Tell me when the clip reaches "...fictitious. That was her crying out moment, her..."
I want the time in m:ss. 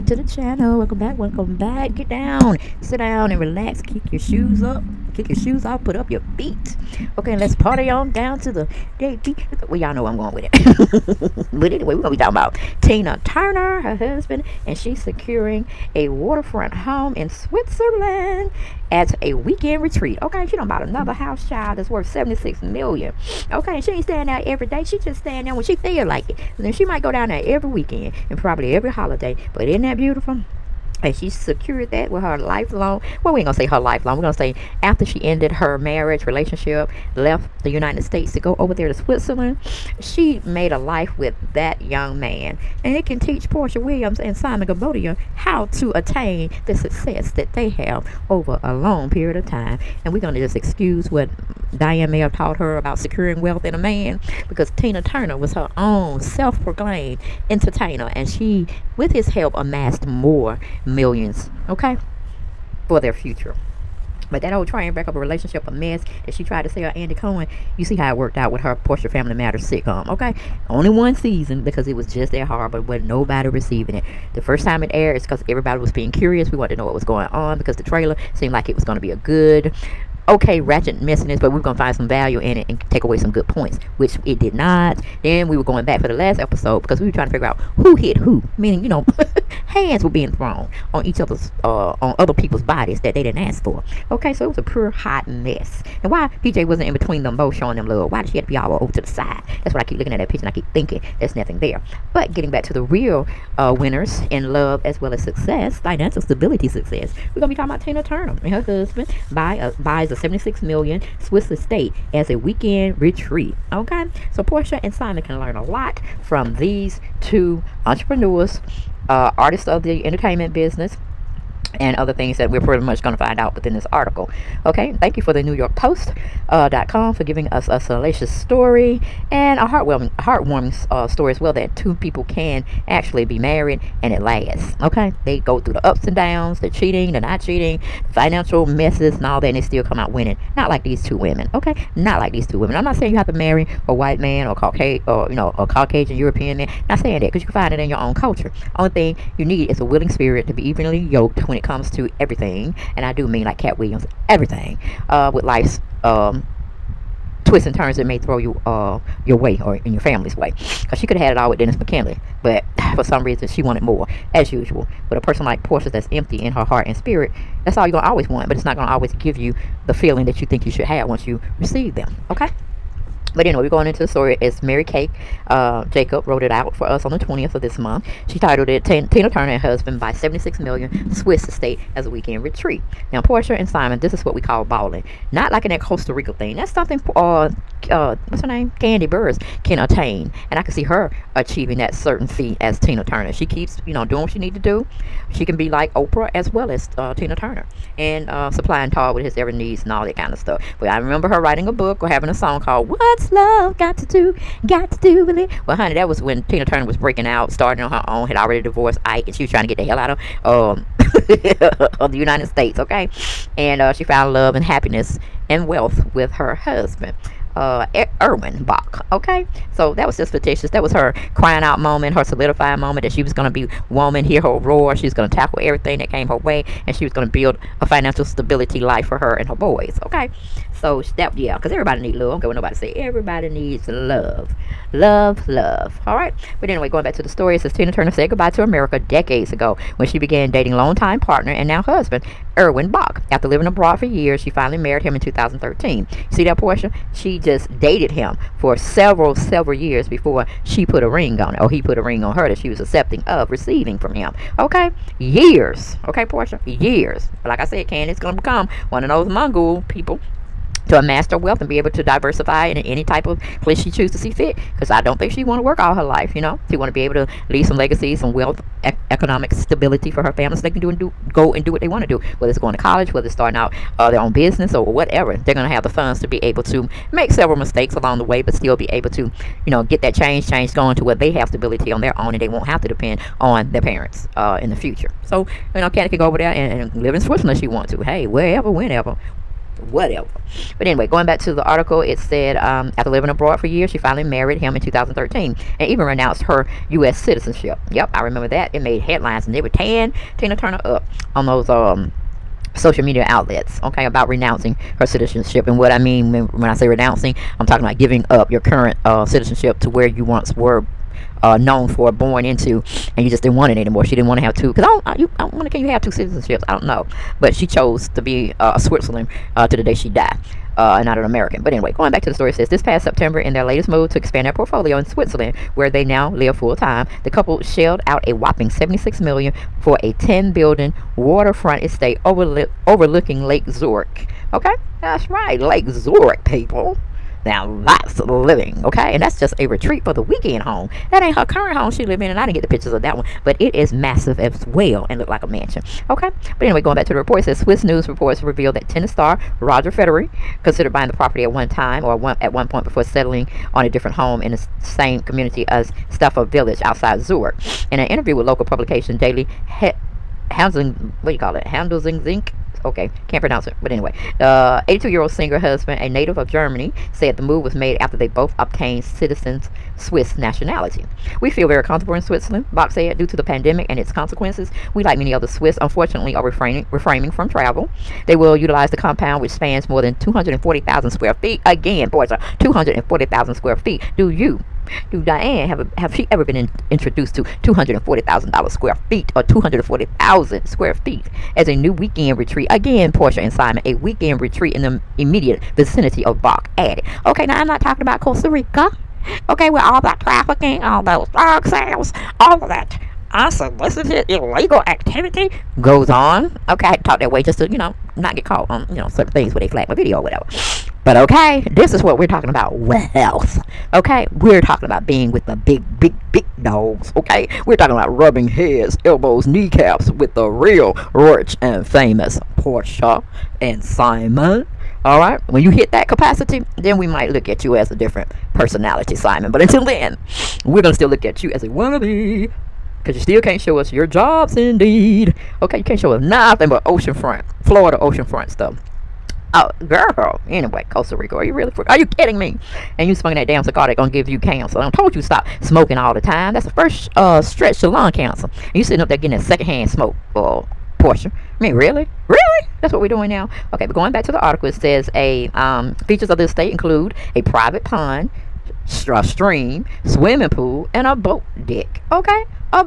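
3:40.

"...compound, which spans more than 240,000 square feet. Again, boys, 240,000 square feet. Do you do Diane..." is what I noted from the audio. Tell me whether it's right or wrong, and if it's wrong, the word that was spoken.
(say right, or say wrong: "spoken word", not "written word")
right.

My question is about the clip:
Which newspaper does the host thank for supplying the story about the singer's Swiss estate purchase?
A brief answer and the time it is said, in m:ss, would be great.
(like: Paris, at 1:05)
New York Post, at 2:05.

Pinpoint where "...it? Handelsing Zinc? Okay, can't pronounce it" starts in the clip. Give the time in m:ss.
6:01.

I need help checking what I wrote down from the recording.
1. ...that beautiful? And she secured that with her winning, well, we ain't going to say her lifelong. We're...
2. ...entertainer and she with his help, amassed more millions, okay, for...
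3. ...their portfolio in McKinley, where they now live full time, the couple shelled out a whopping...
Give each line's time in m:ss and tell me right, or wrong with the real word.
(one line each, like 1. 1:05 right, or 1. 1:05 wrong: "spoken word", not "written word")
1. 0:29 wrong: "lifelong", not "winning"
2. 0:57 right
3. 5:24 wrong: "Switzerland", not "McKinley".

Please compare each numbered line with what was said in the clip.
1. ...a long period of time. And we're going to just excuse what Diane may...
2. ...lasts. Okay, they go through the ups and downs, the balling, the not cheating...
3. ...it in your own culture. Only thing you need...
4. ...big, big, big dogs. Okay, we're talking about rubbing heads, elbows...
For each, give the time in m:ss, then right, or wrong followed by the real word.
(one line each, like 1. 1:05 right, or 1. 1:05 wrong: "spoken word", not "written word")
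1. 0:48 right
2. 2:14 wrong: "cheating", not "balling"
3. 2:27 right
4. 6:55 right.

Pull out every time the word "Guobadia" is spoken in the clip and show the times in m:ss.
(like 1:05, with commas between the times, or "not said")
0:44.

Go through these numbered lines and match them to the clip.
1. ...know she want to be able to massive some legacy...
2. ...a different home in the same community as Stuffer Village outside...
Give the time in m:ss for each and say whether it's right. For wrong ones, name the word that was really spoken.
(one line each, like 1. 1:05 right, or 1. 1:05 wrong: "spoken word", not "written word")
1. 4:26 wrong: "leave", not "massive"
2. 5:53 right.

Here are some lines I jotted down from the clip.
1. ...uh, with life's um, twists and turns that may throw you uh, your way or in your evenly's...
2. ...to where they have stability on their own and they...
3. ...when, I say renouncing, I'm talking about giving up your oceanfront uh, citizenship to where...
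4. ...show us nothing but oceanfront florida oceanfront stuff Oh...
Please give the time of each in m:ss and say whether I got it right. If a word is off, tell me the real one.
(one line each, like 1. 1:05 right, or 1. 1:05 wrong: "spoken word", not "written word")
1. 2:35 wrong: "family", not "evenly"
2. 4:40 right
3. 5:06 wrong: "current", not "oceanfront"
4. 7:15 right.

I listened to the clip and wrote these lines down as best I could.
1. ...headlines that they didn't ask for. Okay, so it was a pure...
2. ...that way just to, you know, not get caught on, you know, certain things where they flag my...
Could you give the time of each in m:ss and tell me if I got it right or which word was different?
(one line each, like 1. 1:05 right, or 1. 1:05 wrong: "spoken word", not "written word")
1. 1:32 wrong: "bodies", not "headlines"
2. 6:47 right.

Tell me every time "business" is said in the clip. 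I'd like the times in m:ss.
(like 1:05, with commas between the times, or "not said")
2:00, 4:34.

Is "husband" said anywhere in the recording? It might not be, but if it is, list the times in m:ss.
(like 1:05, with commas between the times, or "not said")
0:13, 1:48, 2:59, 3:36, 4:01, 6:05.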